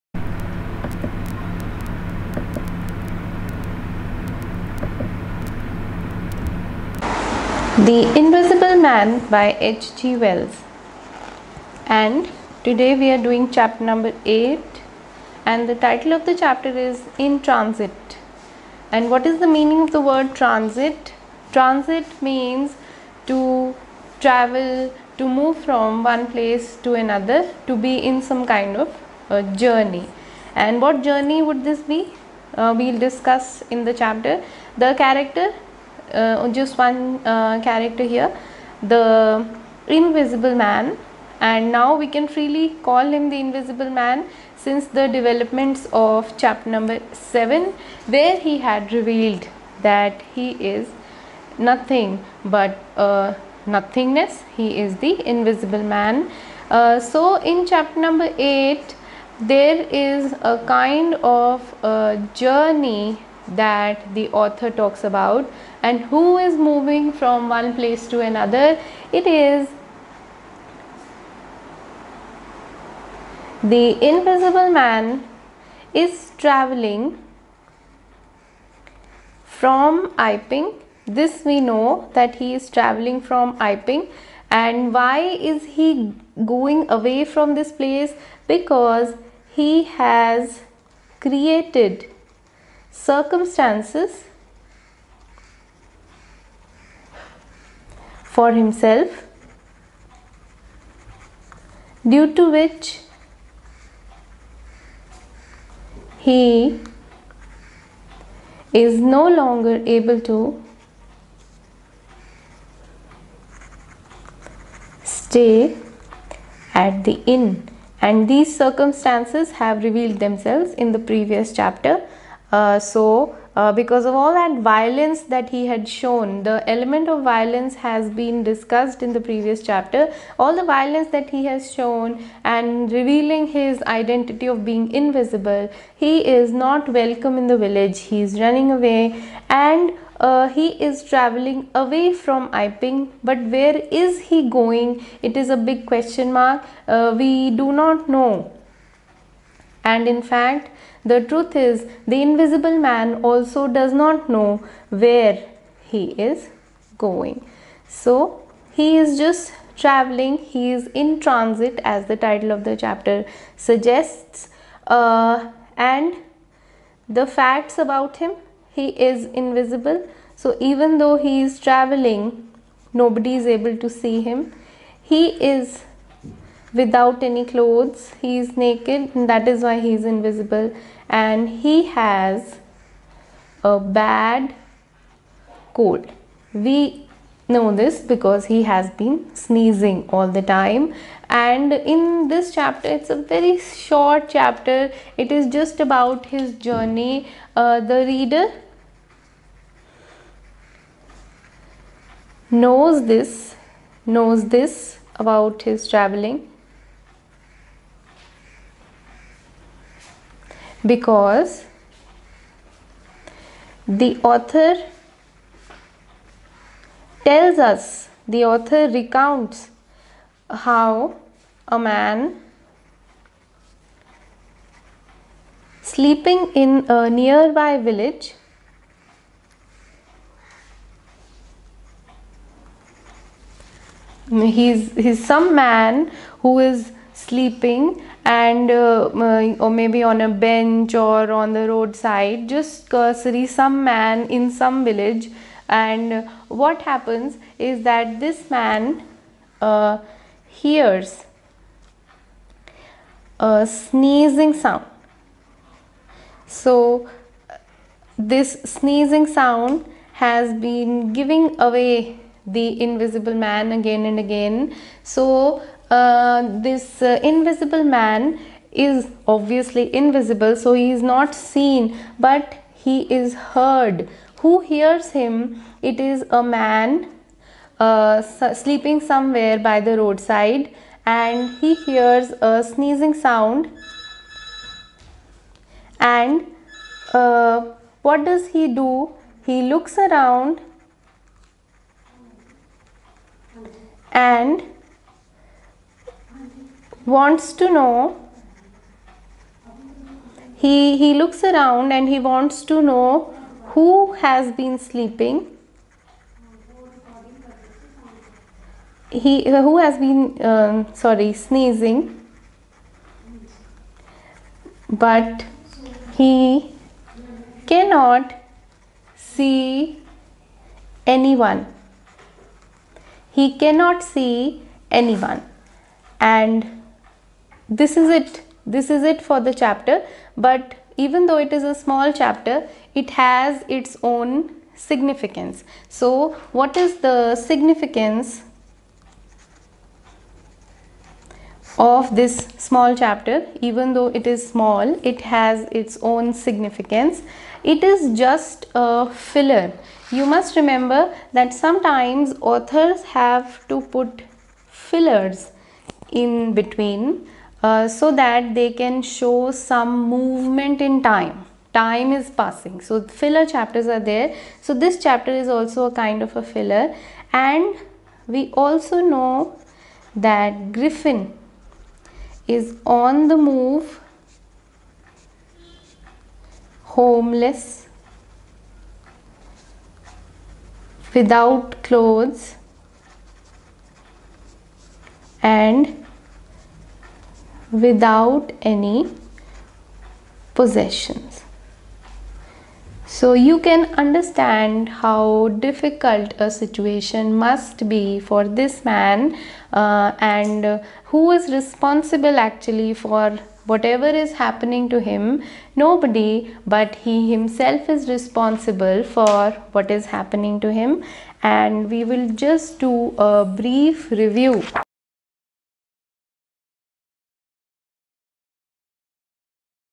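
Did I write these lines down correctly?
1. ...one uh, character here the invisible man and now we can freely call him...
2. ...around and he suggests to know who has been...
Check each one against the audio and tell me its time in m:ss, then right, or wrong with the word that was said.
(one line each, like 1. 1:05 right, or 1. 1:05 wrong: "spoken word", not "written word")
1. 0:36 right
2. 5:01 wrong: "wants", not "suggests".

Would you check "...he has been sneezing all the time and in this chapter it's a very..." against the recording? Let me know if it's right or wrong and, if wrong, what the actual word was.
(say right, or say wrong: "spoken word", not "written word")
right.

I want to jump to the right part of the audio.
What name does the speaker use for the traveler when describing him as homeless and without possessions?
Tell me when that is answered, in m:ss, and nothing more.
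6:10.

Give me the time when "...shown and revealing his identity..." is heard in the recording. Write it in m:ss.
2:11.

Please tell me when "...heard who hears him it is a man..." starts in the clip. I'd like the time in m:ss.
4:33.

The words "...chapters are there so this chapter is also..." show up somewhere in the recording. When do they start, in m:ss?
6:03.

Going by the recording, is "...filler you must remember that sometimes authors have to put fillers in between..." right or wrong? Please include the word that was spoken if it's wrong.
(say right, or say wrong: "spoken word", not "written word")
right.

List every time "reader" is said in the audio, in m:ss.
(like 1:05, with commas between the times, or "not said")
3:18.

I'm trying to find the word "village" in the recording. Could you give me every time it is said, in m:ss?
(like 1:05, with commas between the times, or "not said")
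2:17, 3:47, 4:04.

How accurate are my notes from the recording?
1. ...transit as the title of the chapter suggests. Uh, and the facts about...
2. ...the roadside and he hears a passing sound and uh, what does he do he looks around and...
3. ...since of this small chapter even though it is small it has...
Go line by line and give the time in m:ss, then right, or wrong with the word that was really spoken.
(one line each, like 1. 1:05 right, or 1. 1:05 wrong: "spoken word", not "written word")
1. 2:41 right
2. 4:39 wrong: "sneezing", not "passing"
3. 5:37 wrong: "significance", not "since".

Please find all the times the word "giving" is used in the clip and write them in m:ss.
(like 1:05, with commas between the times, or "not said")
4:21.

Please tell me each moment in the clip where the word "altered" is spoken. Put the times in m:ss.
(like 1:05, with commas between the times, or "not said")
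not said.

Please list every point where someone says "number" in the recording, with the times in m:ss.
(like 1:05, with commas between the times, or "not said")
0:13, 0:46, 0:57.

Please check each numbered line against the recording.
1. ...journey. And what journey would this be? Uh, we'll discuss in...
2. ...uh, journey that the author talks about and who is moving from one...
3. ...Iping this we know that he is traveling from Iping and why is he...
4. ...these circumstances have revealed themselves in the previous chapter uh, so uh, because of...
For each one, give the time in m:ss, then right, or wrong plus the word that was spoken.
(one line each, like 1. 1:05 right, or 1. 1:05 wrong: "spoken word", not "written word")
1. 0:29 right
2. 1:01 right
3. 1:20 right
4. 1:58 right.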